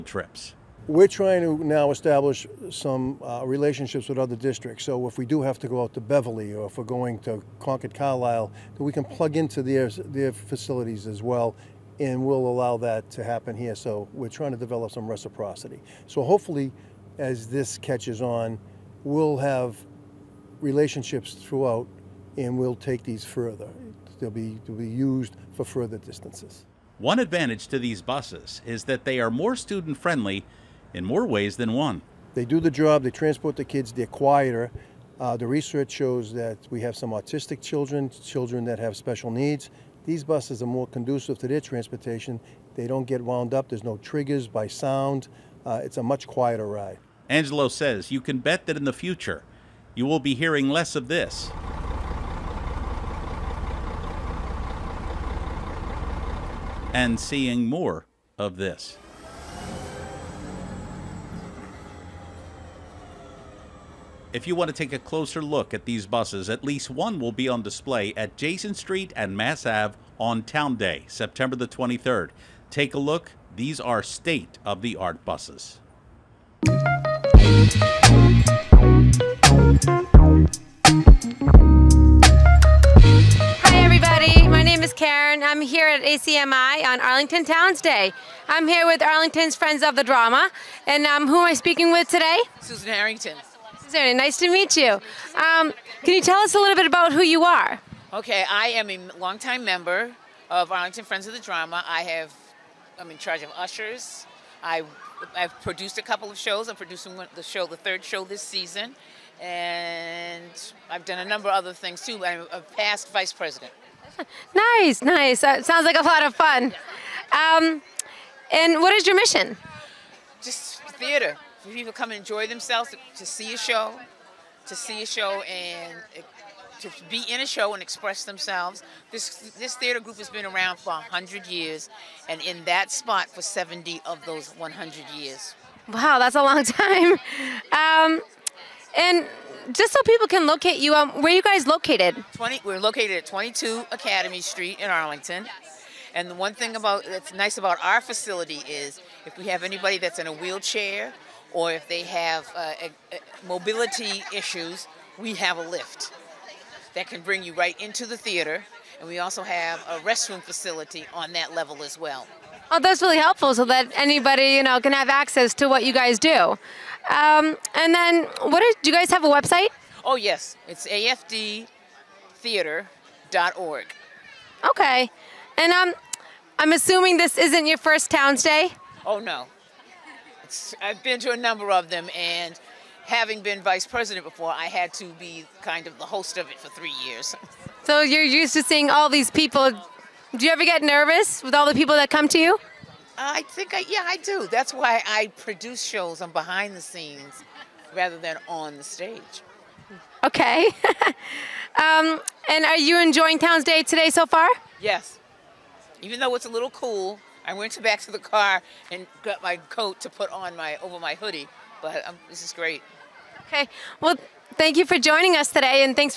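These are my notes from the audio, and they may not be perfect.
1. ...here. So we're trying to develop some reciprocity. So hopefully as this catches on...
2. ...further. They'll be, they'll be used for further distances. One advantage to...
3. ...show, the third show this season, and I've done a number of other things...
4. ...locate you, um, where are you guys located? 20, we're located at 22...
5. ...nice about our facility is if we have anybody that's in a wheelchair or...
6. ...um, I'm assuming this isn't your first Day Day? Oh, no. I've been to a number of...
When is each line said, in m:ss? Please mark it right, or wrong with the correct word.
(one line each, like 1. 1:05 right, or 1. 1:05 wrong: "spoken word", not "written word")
1. 0:13 right
2. 0:23 right
3. 1:47 right
4. 2:20 right
5. 2:27 right
6. 2:55 wrong: "Towns", not "Day".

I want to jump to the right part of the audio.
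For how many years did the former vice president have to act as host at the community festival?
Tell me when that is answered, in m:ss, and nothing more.
3:06.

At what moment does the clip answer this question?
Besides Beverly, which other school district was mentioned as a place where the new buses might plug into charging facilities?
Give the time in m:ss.
0:07.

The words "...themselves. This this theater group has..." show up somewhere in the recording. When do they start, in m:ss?
2:08.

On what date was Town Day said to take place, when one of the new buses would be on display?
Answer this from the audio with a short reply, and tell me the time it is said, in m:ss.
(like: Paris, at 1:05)
September 23, at 1:11.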